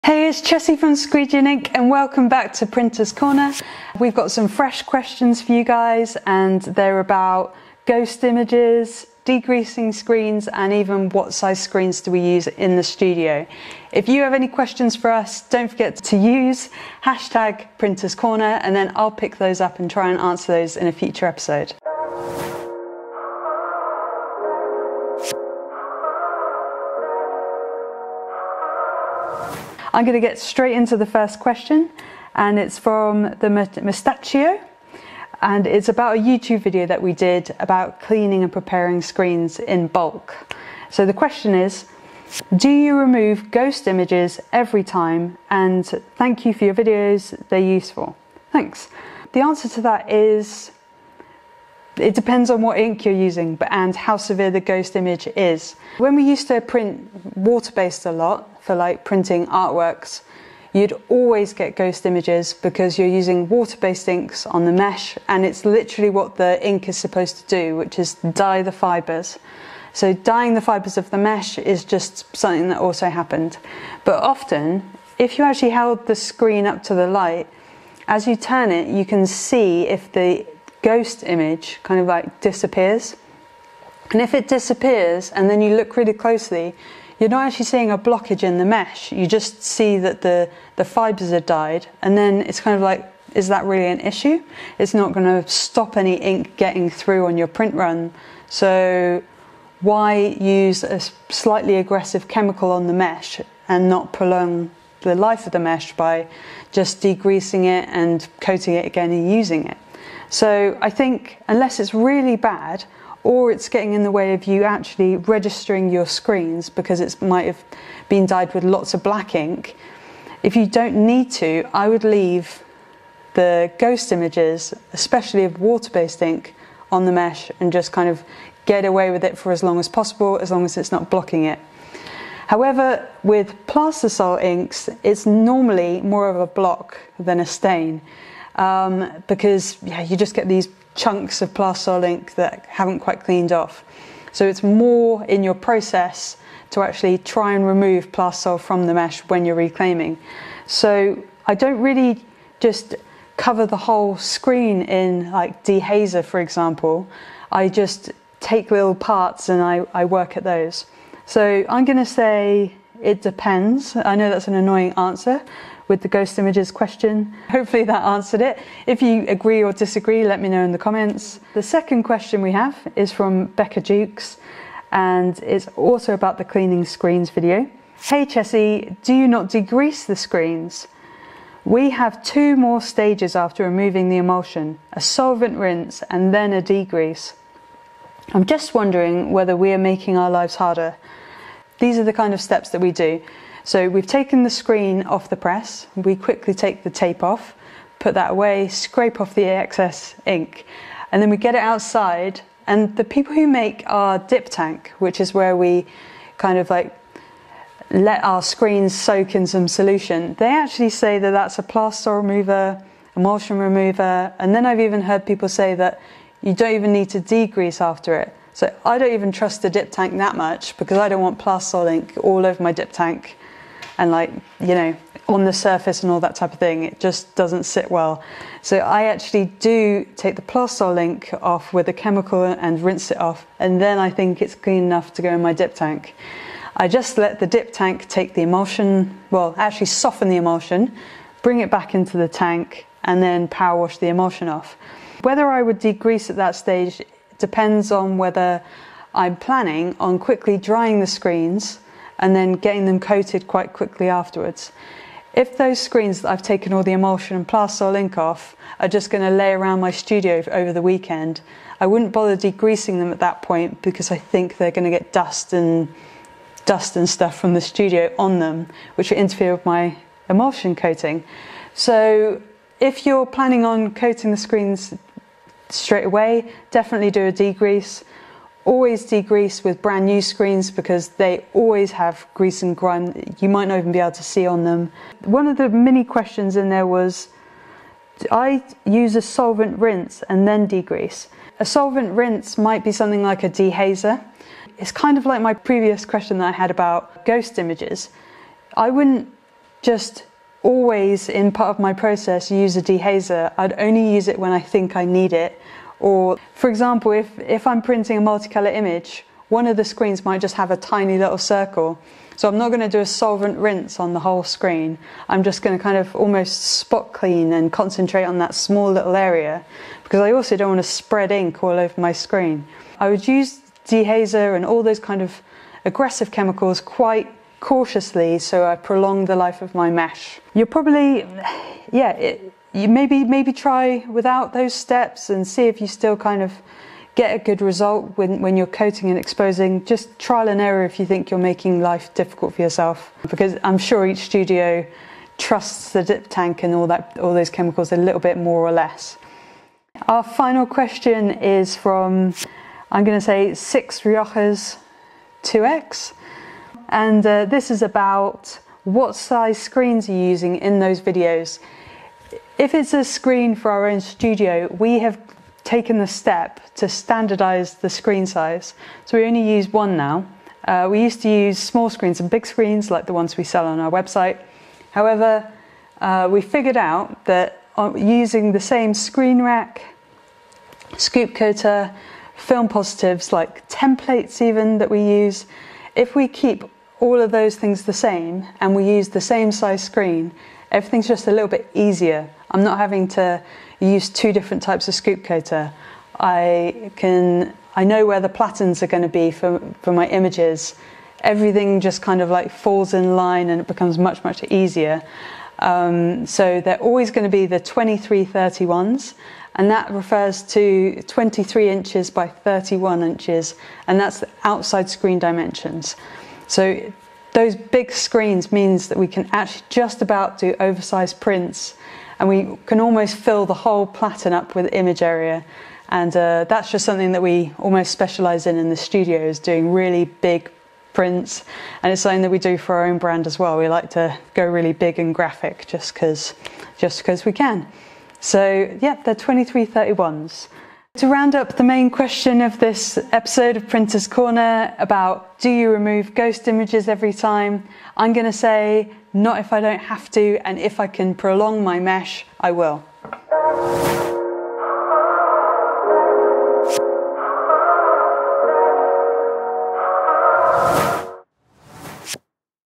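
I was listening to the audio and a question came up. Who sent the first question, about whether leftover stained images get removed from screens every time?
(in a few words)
the Mustachio.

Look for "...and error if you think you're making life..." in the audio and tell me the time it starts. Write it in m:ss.
5:40.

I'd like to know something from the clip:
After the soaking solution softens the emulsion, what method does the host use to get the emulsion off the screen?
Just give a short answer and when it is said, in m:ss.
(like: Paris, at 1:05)
power wash, at 4:03.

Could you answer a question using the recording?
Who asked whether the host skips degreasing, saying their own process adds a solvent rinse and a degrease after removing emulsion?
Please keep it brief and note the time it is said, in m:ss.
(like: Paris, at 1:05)
Becca Jukes, at 2:53.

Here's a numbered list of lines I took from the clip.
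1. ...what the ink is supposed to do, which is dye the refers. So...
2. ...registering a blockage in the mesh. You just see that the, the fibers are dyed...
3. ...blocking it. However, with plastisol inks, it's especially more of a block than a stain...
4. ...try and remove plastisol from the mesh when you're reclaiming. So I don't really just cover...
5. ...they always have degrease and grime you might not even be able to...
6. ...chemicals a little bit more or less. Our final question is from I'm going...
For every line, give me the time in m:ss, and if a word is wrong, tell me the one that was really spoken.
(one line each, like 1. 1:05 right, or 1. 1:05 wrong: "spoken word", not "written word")
1. 1:06 wrong: "fibers", not "refers"
2. 1:27 wrong: "seeing", not "registering"
3. 2:11 wrong: "normally", not "especially"
4. 2:27 right
5. 4:41 wrong: "grease", not "degrease"
6. 5:47 right.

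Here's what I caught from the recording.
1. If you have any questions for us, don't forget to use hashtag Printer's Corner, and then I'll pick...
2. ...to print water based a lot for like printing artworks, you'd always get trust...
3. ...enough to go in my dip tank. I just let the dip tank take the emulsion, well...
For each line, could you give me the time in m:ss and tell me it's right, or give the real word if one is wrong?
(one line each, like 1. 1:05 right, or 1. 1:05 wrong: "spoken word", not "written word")
1. 0:13 right
2. 0:56 wrong: "ghost", not "trust"
3. 3:54 right.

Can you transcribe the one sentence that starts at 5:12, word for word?
So I'm not going to do a solvent rinse on the whole screen.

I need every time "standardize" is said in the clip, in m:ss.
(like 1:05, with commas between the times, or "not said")
6:06.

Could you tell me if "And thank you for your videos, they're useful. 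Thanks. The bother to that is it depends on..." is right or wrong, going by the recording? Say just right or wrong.
wrong.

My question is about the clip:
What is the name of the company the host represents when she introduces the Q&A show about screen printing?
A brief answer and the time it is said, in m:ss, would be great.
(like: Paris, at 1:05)
Squeegee and Ink, at 0:00.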